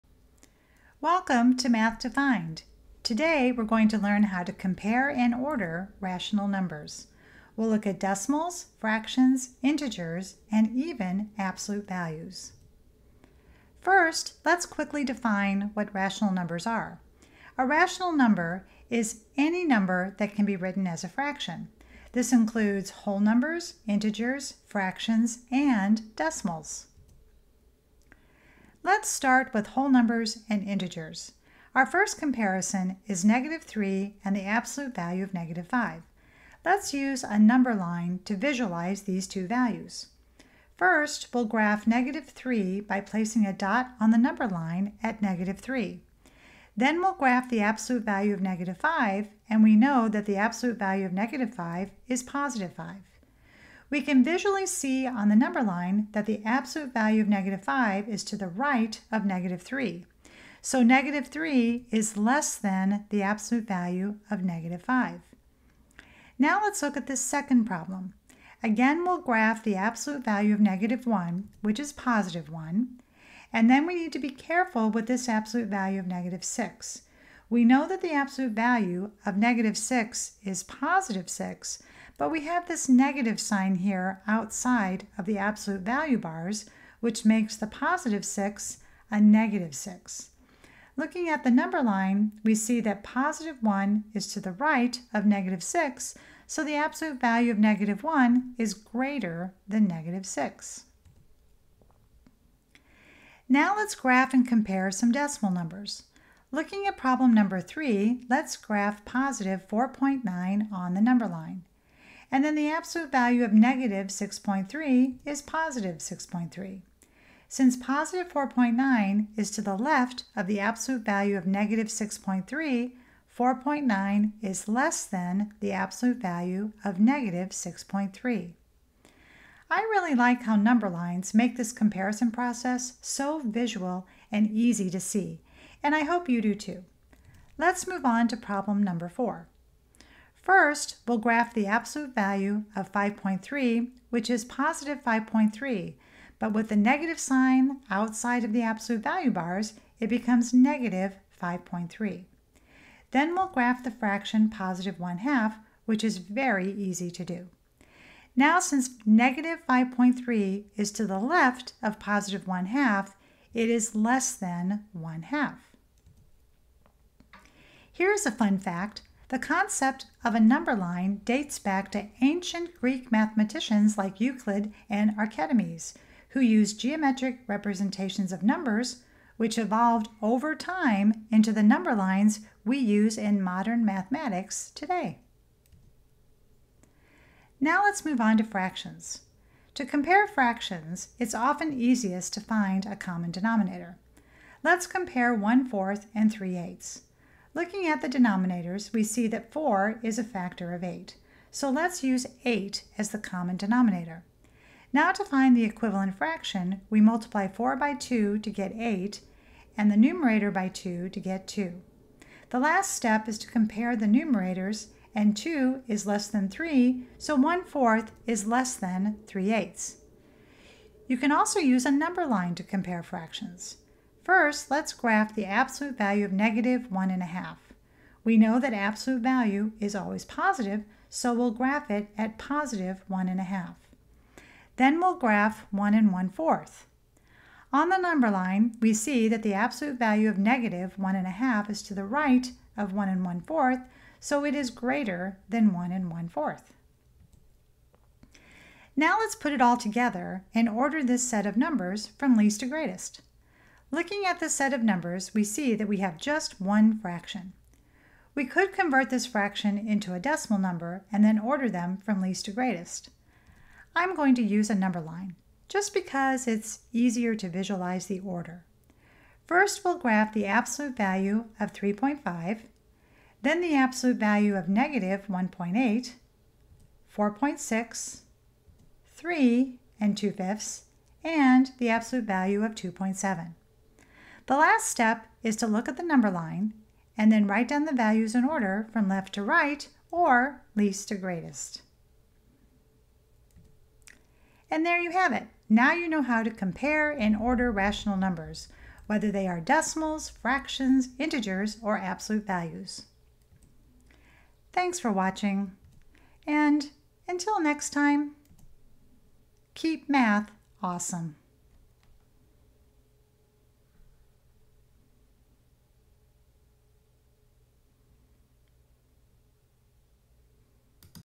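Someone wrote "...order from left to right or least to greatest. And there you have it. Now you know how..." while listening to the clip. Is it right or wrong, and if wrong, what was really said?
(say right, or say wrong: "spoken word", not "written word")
right.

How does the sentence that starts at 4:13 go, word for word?
Looking at this set of numbers, we see that we have just one fraction.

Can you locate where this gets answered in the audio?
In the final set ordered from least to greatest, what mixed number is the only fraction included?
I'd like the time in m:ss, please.
4:39.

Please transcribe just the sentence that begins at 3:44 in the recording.
First, let's graph the absolute value of negative 1.5.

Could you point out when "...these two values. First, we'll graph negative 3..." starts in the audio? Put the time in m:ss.
0:39.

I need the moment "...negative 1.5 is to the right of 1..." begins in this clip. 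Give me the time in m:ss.
4:00.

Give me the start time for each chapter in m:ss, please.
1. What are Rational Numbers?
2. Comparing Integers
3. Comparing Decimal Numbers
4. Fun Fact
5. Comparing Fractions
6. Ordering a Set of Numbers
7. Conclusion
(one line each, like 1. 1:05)
1. 0:15
2. 0:31
3. 1:43
4. 2:49
5. 3:10
6. 4:08
7. 4:56.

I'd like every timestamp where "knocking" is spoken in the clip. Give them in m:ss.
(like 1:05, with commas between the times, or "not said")
not said.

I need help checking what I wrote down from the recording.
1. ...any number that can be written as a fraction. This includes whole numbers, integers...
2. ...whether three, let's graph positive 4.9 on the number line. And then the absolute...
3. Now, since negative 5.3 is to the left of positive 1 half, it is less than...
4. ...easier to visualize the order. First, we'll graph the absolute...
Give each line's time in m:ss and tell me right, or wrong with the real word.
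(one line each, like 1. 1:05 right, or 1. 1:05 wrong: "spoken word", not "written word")
1. 0:19 right
2. 1:47 wrong: "number", not "whether"
3. 2:38 right
4. 4:26 right.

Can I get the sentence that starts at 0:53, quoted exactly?
We can visually see on the number line that the absolute value of negative 5 is to the right of negative 3.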